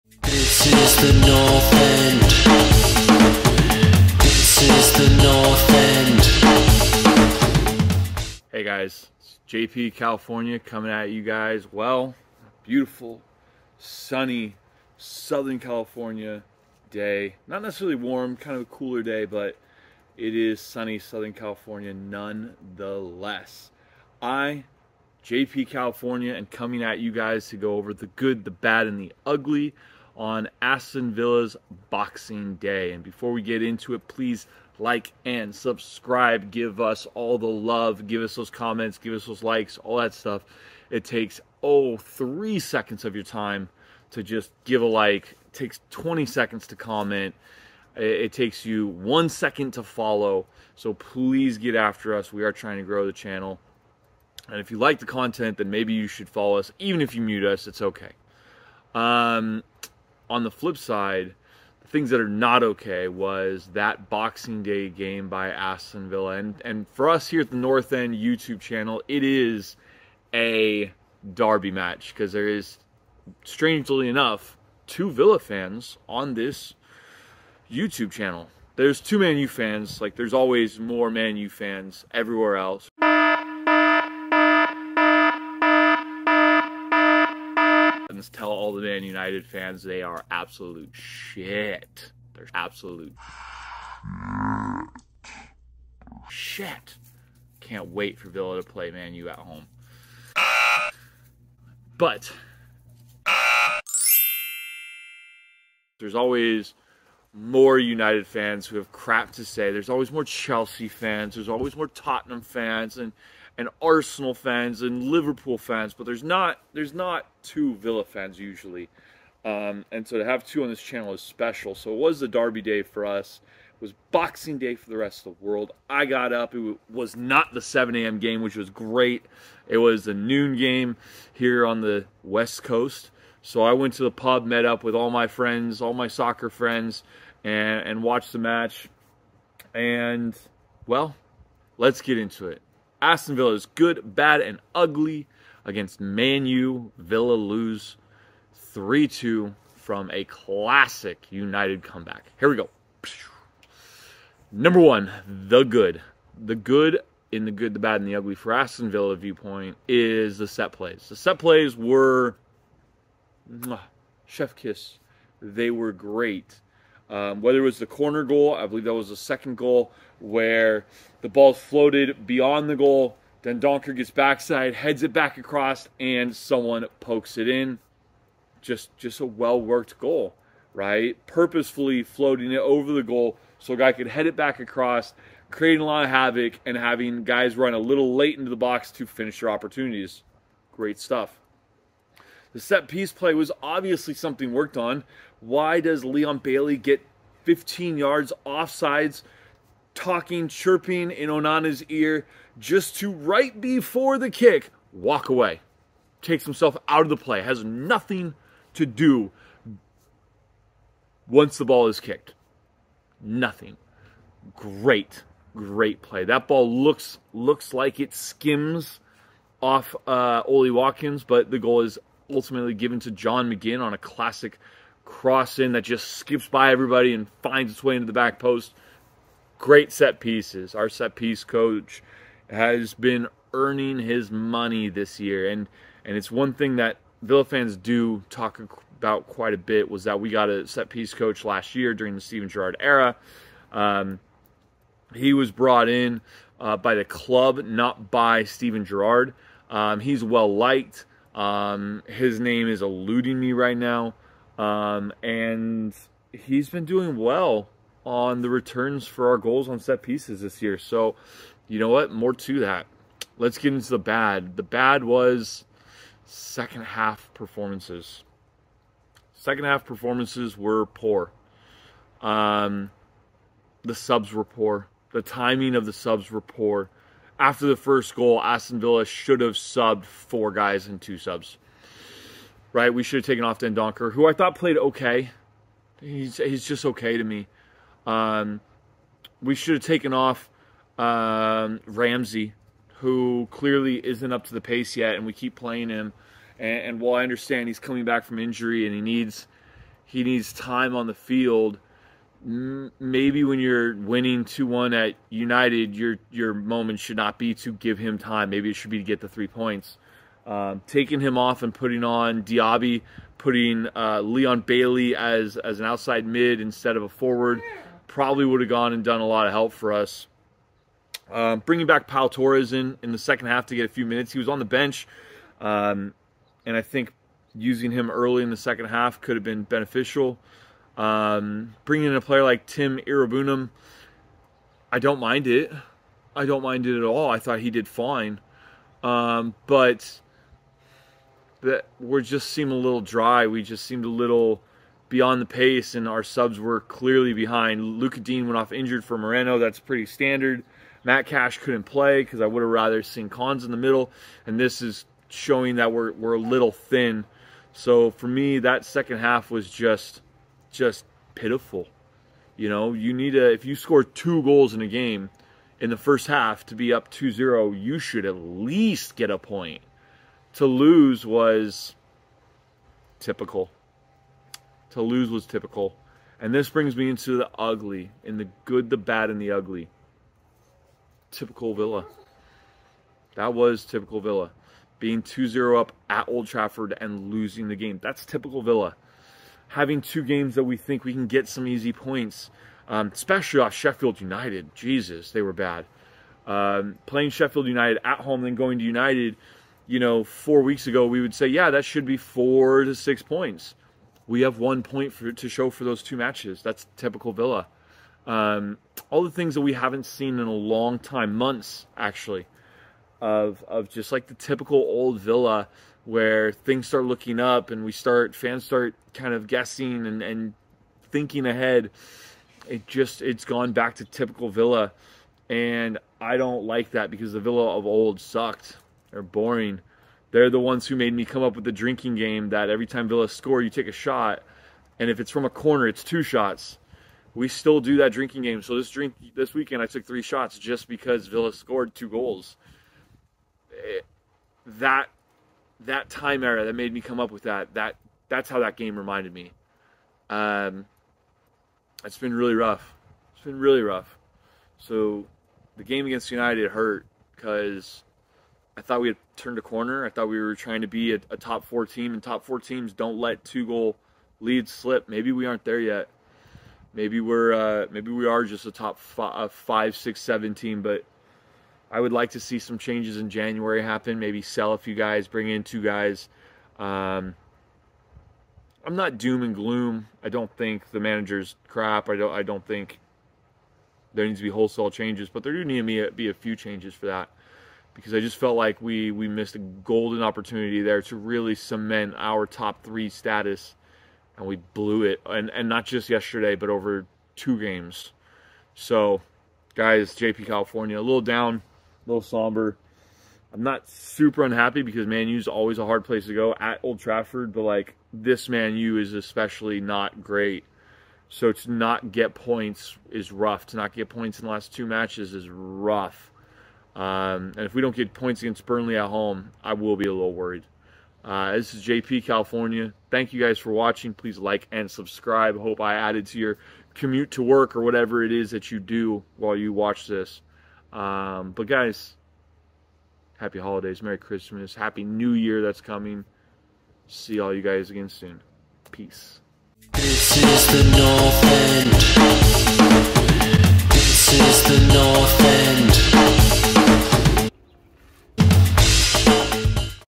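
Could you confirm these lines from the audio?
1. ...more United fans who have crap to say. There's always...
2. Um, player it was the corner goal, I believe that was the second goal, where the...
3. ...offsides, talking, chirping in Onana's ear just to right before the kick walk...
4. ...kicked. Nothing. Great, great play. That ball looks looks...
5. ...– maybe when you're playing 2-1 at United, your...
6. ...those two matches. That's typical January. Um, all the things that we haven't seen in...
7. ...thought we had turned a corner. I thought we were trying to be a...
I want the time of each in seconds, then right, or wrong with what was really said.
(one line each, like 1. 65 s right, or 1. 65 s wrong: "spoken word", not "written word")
1. 107 s right
2. 167 s wrong: "whether", not "player"
3. 198 s right
4. 211 s right
5. 301 s wrong: "winning", not "playing"
6. 405 s wrong: "Villa", not "January"
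7. 458 s right.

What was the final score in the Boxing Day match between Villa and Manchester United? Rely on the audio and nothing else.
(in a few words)
3-2.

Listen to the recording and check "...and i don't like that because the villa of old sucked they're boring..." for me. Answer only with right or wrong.
right.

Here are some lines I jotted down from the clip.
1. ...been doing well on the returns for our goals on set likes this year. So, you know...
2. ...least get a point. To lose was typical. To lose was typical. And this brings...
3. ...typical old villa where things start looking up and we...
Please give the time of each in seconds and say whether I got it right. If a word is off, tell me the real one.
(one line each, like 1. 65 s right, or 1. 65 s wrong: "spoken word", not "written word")
1. 256 s wrong: "pieces", not "likes"
2. 368 s right
3. 414 s right.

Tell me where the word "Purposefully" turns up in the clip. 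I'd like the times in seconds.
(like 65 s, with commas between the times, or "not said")
181 s.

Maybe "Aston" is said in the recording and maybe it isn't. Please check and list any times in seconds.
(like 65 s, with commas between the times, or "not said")
30 s, 65 s, 143 s, 158 s, 278 s.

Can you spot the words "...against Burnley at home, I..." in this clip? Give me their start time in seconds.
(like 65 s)
518 s.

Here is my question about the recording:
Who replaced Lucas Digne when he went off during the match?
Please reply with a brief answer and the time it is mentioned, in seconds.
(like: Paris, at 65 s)
Moreno, at 349 s.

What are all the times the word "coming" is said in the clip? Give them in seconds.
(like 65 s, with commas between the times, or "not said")
10 s, 26 s, 297 s, 535 s.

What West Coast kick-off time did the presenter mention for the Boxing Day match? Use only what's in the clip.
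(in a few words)
noon.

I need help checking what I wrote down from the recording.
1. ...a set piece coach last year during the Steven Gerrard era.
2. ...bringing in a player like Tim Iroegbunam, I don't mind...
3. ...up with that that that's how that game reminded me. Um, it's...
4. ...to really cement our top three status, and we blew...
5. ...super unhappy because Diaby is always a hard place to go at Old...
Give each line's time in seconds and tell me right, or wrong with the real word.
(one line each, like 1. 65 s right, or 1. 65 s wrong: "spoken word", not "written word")
1. 240 s right
2. 331 s right
3. 447 s right
4. 491 s right
5. 503 s wrong: "Man", not "Diaby".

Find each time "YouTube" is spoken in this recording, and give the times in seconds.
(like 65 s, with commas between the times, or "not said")
68 s, 77 s.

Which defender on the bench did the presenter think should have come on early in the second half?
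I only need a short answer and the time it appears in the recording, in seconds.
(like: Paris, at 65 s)
Pau Torres, at 322 s.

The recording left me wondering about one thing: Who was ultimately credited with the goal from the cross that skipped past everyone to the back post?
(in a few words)
John McGinn.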